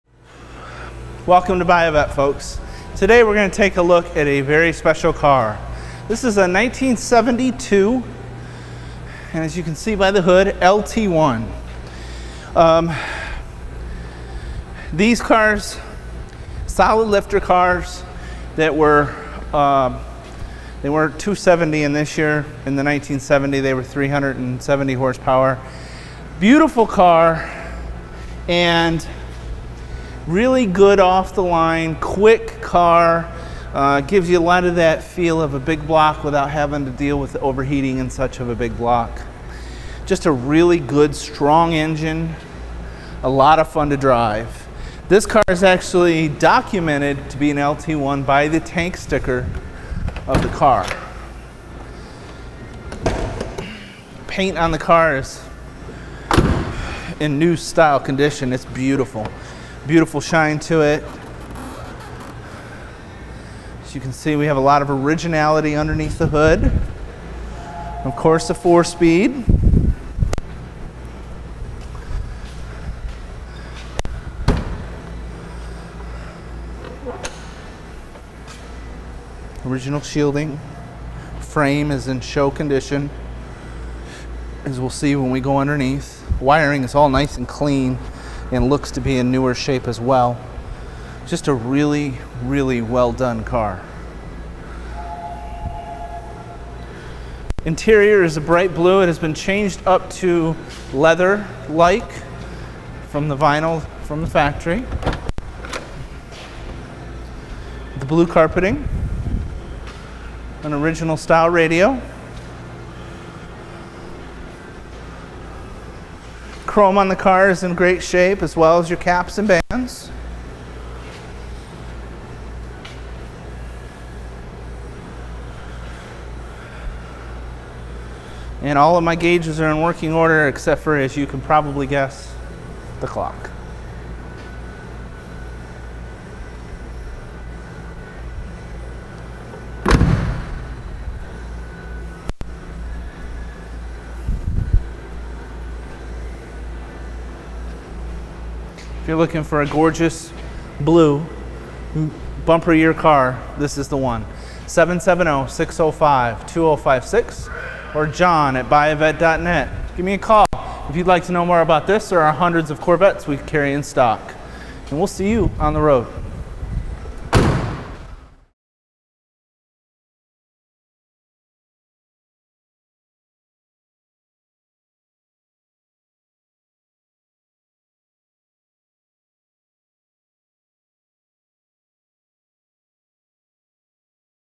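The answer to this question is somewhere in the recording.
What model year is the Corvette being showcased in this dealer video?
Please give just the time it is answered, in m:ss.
0:06.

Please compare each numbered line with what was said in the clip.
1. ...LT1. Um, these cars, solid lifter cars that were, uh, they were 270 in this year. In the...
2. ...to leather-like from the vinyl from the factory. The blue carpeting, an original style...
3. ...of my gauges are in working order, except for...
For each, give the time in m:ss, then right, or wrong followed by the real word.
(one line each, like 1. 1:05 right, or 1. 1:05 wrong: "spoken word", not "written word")
1. 0:10 right
2. 1:40 right
3. 2:08 right.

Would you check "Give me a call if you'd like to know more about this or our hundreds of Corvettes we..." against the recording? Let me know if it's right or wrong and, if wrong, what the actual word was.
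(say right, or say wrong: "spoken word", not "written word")
right.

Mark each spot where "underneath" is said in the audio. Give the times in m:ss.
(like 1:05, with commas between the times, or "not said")
1:05, 1:25.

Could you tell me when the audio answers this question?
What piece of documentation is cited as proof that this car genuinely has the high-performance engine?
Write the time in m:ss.
0:48.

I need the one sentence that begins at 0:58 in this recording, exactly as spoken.
It's beautiful beautiful shine to it.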